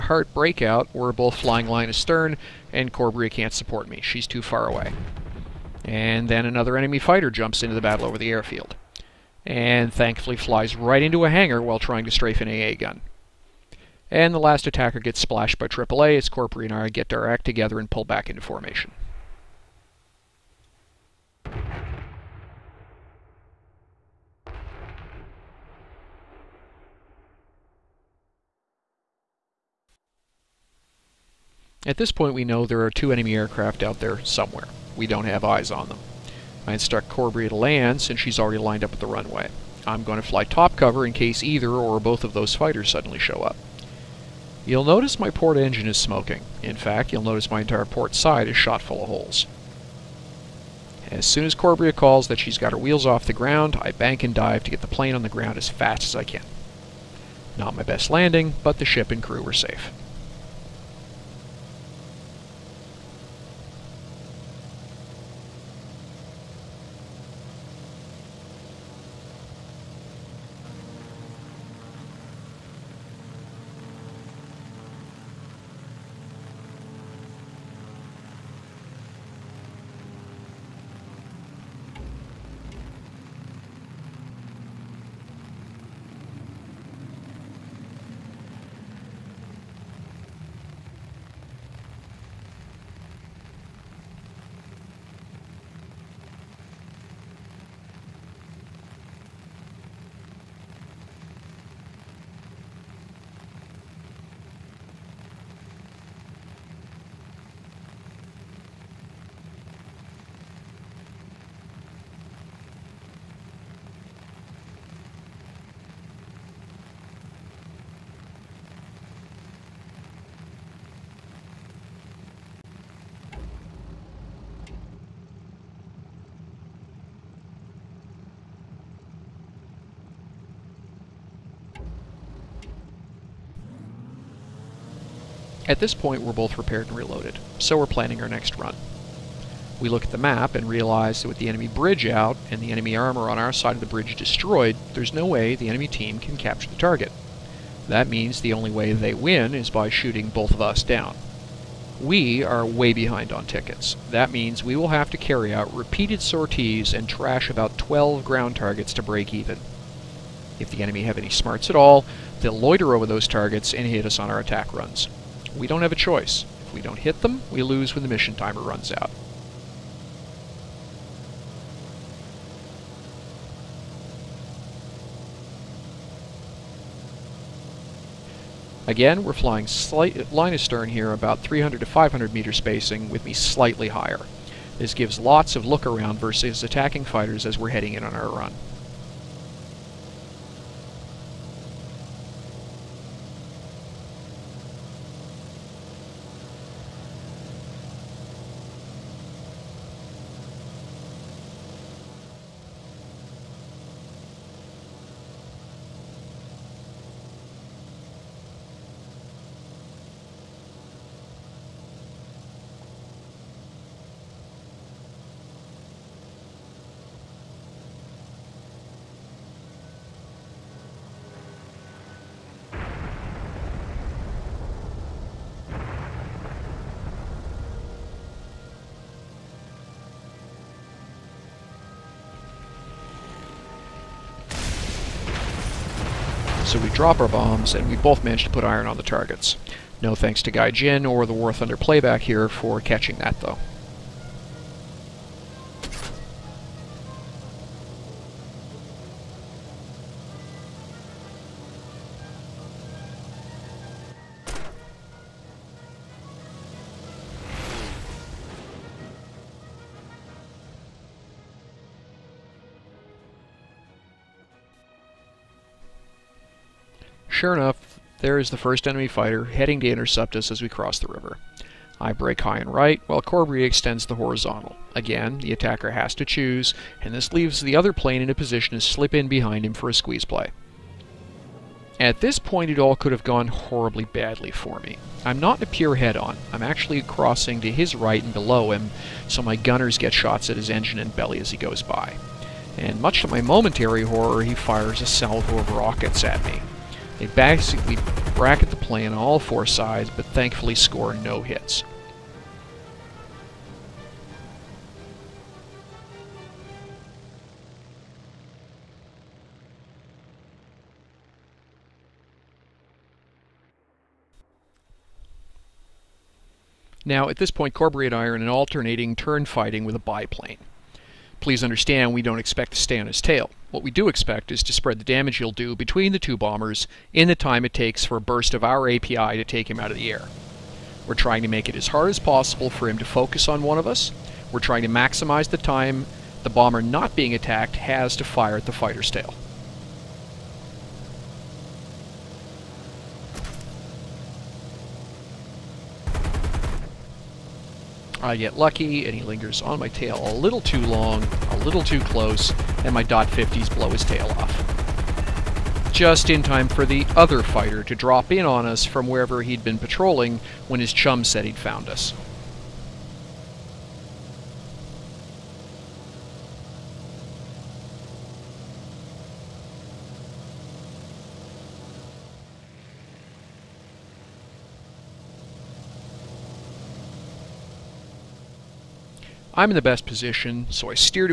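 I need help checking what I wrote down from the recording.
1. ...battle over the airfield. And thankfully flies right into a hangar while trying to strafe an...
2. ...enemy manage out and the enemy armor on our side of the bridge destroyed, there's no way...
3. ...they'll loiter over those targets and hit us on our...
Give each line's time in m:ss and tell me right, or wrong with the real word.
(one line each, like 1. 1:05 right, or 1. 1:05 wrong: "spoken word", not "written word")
1. 0:07 right
2. 2:21 wrong: "bridge", not "manage"
3. 2:42 right.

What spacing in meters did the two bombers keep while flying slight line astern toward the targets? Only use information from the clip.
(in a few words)
300 to 500 meters.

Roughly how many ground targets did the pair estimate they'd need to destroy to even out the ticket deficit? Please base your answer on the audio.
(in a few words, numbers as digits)
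12.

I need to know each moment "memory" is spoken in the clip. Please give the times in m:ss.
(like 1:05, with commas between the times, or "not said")
not said.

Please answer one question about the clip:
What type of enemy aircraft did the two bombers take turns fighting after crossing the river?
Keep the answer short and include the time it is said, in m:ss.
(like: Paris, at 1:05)
A biplane, at 5:19.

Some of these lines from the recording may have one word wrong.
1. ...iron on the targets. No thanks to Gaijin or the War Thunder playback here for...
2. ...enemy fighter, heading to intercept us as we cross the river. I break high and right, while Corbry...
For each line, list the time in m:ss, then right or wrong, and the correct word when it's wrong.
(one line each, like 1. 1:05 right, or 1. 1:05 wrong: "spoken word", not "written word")
1. 3:58 right
2. 4:28 right.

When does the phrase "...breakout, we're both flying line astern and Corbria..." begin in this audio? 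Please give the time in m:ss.
0:00.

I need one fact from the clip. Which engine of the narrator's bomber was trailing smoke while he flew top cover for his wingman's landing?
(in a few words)
Port engine.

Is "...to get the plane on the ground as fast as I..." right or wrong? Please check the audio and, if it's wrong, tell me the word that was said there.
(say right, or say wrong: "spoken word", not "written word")
right.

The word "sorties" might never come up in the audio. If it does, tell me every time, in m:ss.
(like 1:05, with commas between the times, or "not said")
2:36.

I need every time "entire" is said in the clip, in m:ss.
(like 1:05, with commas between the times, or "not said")
0:47.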